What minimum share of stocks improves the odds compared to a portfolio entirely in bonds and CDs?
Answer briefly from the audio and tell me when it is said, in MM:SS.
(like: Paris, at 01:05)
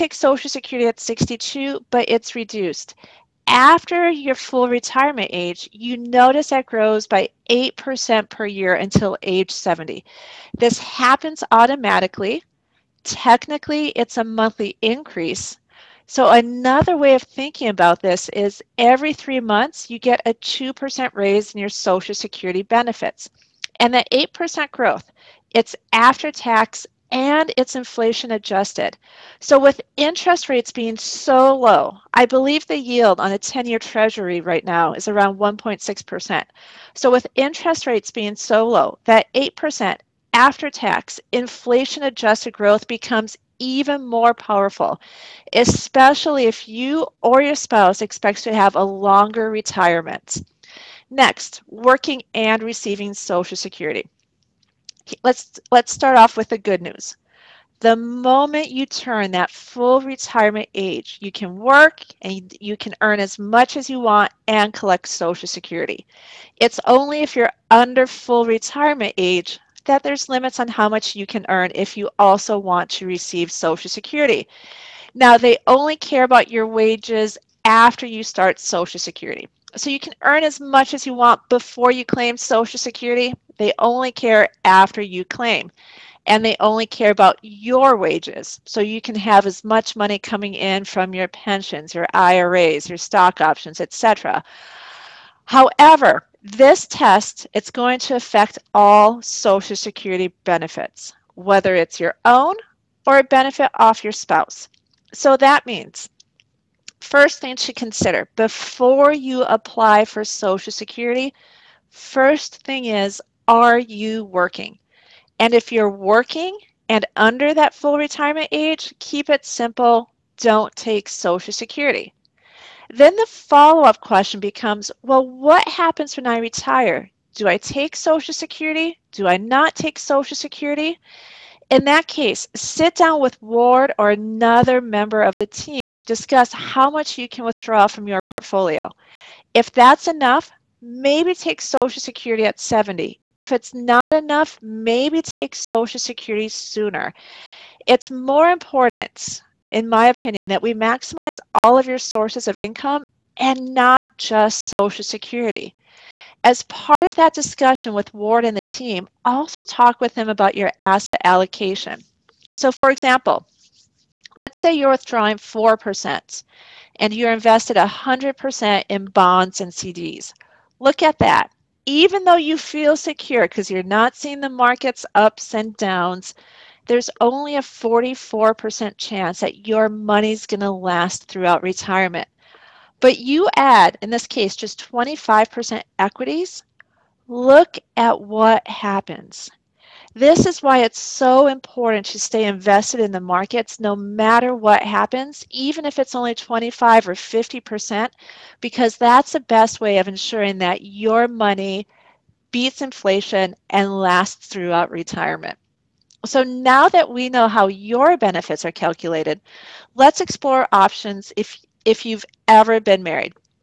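25%, at 03:04.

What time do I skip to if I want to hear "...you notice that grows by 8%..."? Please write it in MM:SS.
00:05.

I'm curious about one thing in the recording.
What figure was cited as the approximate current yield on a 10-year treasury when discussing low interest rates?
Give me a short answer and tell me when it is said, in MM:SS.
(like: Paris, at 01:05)
1.6%, at 00:35.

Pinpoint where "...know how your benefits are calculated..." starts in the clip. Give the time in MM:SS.
03:27.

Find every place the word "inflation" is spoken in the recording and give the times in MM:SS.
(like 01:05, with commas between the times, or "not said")
00:27, 00:41, 03:22.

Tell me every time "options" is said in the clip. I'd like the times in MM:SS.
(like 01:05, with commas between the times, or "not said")
01:33, 03:30.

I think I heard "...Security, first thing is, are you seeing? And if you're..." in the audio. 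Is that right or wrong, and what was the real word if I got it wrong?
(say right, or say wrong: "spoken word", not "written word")
wrong: "working", not "seeing".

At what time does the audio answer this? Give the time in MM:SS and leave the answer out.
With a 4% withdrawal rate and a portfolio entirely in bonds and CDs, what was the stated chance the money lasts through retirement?
02:57.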